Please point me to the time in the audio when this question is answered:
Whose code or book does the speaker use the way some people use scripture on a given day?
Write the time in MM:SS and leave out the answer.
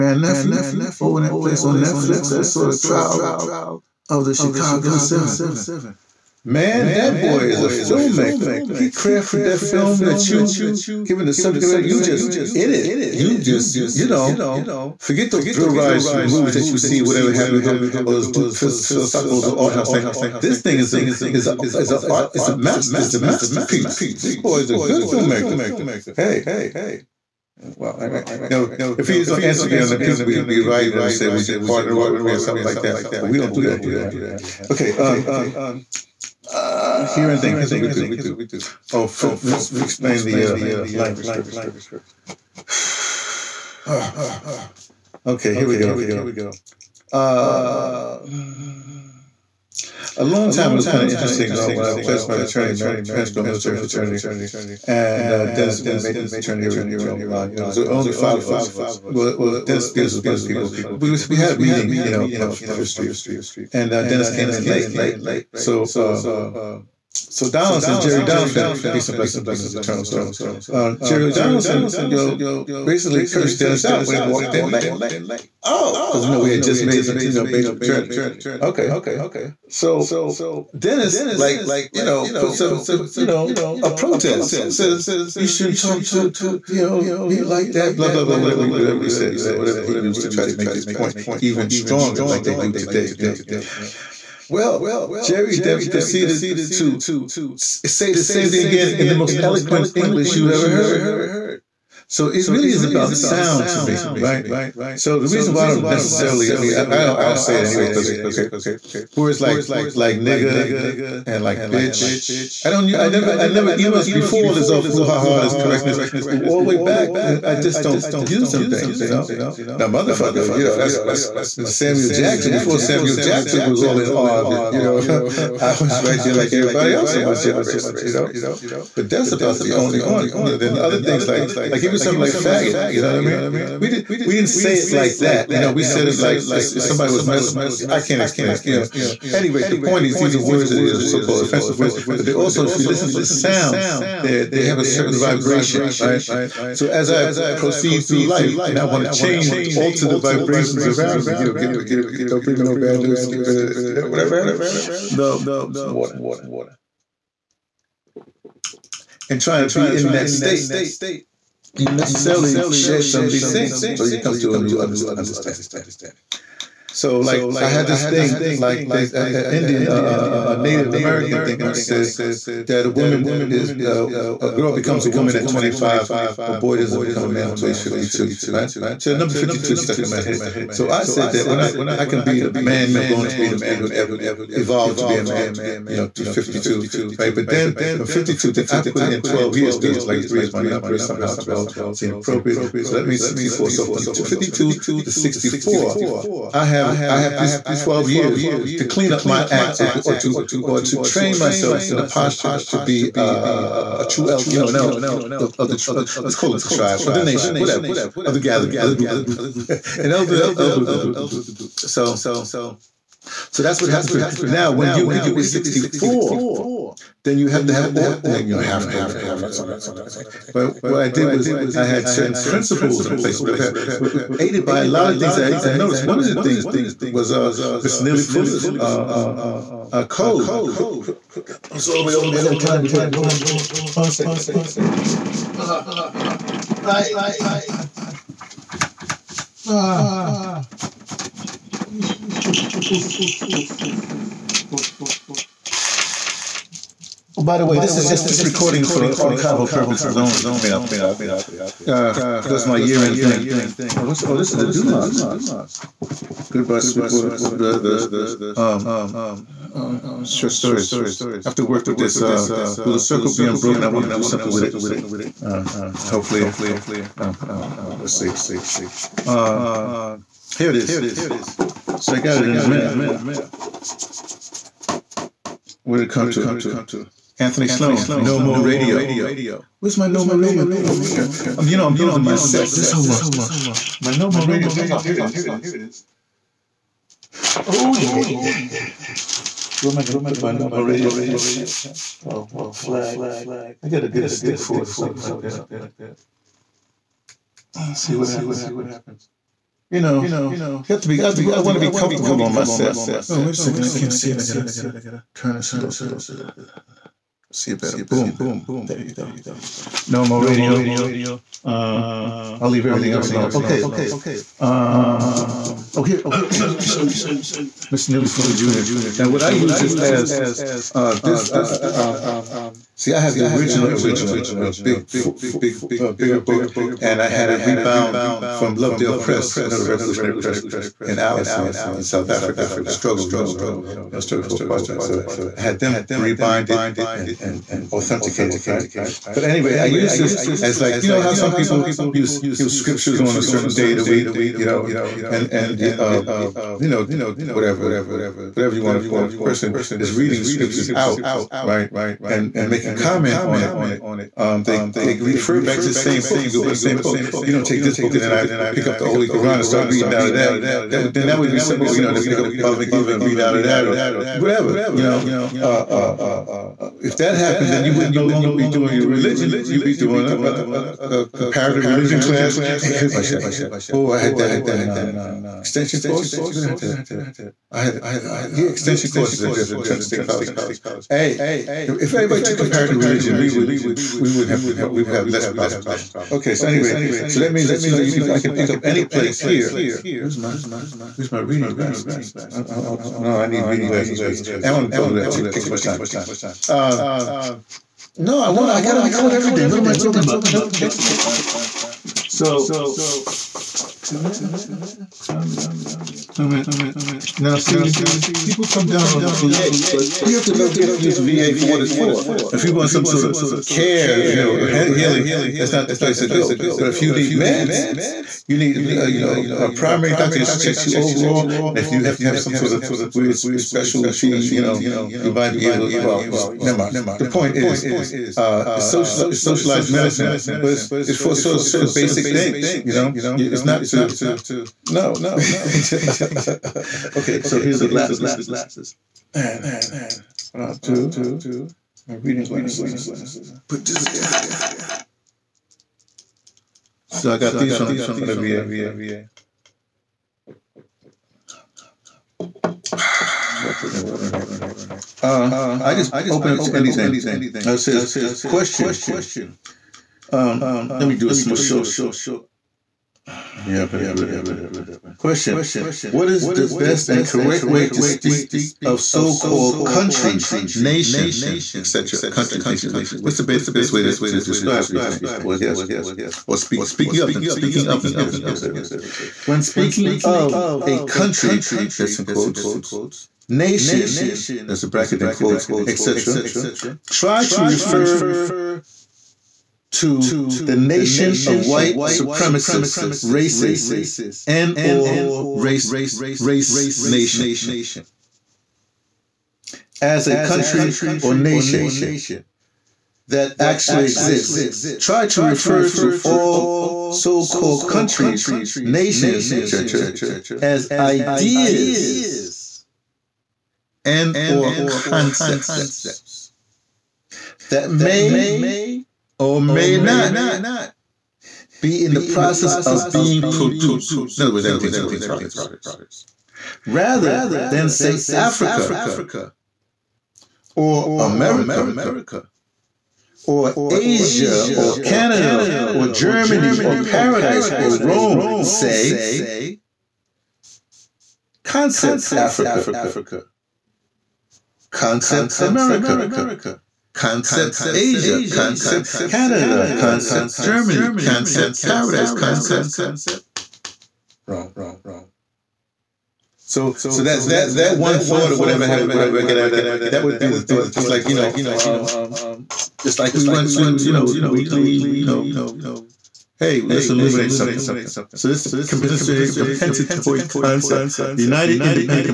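05:18.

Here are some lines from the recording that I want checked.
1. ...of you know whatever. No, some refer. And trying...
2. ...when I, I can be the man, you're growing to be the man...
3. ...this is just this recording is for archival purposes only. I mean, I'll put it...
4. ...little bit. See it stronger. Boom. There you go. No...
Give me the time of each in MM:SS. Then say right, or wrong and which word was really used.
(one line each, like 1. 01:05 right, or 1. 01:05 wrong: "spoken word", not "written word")
1. 02:33 wrong: "water", not "refer"
2. 03:01 right
3. 04:07 right
4. 05:05 wrong: "better", not "stronger".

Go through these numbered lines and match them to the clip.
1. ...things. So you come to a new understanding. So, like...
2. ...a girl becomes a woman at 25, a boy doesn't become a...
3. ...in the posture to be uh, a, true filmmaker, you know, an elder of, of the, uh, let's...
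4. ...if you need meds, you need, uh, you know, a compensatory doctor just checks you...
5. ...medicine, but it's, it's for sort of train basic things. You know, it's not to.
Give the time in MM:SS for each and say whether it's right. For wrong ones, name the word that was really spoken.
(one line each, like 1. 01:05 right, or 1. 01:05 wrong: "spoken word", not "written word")
1. 02:43 right
2. 02:54 right
3. 03:21 wrong: "elder", not "filmmaker"
4. 06:56 wrong: "primary", not "compensatory"
5. 07:09 wrong: "certain", not "train".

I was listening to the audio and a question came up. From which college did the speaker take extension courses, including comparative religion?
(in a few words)
Trenton State College.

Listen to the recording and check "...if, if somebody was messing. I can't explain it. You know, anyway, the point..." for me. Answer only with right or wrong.
right.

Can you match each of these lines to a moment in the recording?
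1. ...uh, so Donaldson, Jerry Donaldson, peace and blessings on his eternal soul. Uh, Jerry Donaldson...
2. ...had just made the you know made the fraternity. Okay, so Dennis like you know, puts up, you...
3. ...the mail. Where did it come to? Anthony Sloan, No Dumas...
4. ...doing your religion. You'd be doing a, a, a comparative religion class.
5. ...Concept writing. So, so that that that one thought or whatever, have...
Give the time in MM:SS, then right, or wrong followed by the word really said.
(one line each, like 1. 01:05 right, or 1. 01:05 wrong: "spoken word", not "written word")
1. 01:05 right
2. 01:16 right
3. 04:32 wrong: "More", not "Dumas"
4. 06:08 right
5. 09:12 wrong: "wrong", not "writing".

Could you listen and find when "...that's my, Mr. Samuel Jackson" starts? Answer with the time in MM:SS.
02:00.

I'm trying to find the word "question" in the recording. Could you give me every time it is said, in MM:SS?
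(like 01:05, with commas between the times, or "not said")
07:38, 07:45.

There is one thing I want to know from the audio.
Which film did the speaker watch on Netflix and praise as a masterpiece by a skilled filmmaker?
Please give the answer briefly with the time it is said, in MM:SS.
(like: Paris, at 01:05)
The Trial of the Chicago Seven, at 00:02.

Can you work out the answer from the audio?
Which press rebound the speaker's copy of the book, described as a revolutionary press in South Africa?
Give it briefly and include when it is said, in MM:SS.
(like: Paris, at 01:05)
Lovedale Press, at 05:28.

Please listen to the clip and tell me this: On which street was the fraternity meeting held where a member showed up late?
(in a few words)
55th Street.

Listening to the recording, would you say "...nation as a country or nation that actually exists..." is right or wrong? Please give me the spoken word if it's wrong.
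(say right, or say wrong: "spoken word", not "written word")
right.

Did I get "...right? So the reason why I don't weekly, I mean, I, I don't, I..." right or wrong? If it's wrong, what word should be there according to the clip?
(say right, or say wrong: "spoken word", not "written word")
wrong: "necessarily", not "weekly".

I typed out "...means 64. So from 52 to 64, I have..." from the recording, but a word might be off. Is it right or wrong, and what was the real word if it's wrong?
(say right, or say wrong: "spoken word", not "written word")
right.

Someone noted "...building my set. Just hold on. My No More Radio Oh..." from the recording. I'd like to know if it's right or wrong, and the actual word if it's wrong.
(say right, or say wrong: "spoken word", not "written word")
right.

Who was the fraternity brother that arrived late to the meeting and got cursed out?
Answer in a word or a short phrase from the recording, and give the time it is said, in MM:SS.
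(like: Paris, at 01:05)
Dennis Spears, at 00:59.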